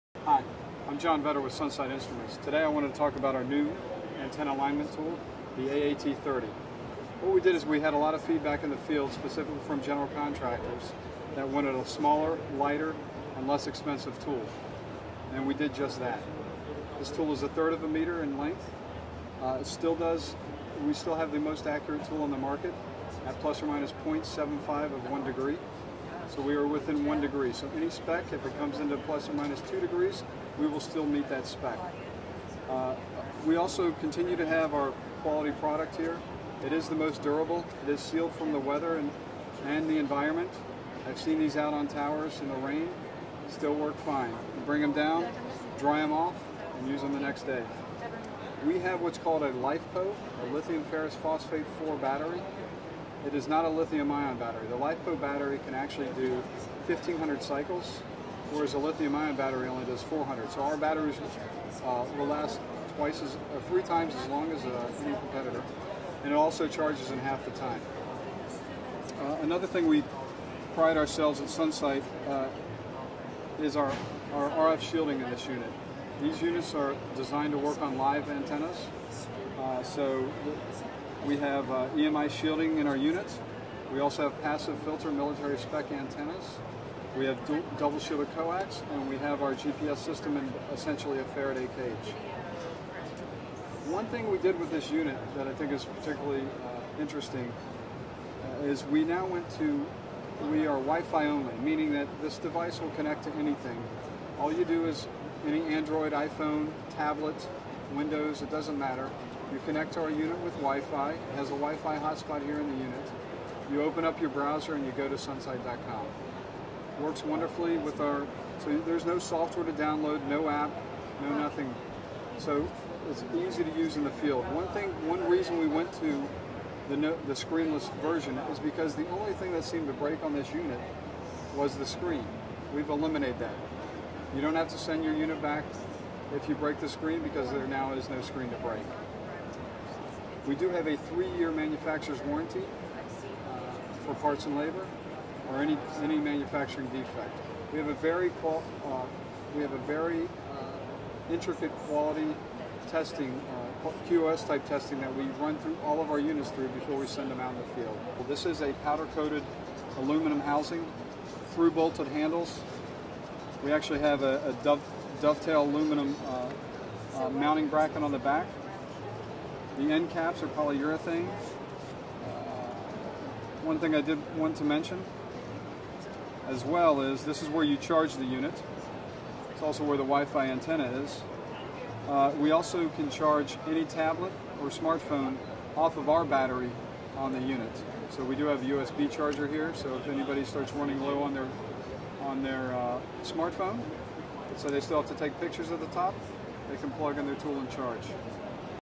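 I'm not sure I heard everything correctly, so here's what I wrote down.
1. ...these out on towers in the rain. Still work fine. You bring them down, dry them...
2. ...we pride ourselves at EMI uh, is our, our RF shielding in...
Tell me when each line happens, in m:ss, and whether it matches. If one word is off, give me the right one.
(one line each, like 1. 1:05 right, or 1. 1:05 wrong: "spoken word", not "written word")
1. 0:41 right
2. 1:09 wrong: "Sunsight", not "EMI".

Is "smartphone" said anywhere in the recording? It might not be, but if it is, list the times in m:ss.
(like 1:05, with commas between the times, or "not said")
3:04, 3:13.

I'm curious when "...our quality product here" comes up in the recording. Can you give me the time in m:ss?
0:34.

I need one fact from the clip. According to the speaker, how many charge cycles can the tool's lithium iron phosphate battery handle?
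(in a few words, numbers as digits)
1500.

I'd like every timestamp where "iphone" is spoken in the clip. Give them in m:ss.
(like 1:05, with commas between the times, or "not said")
1:46.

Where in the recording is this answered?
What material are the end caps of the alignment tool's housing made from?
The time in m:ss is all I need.
2:50.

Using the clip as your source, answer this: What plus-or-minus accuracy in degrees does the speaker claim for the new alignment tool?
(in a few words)
0.75 of one degree.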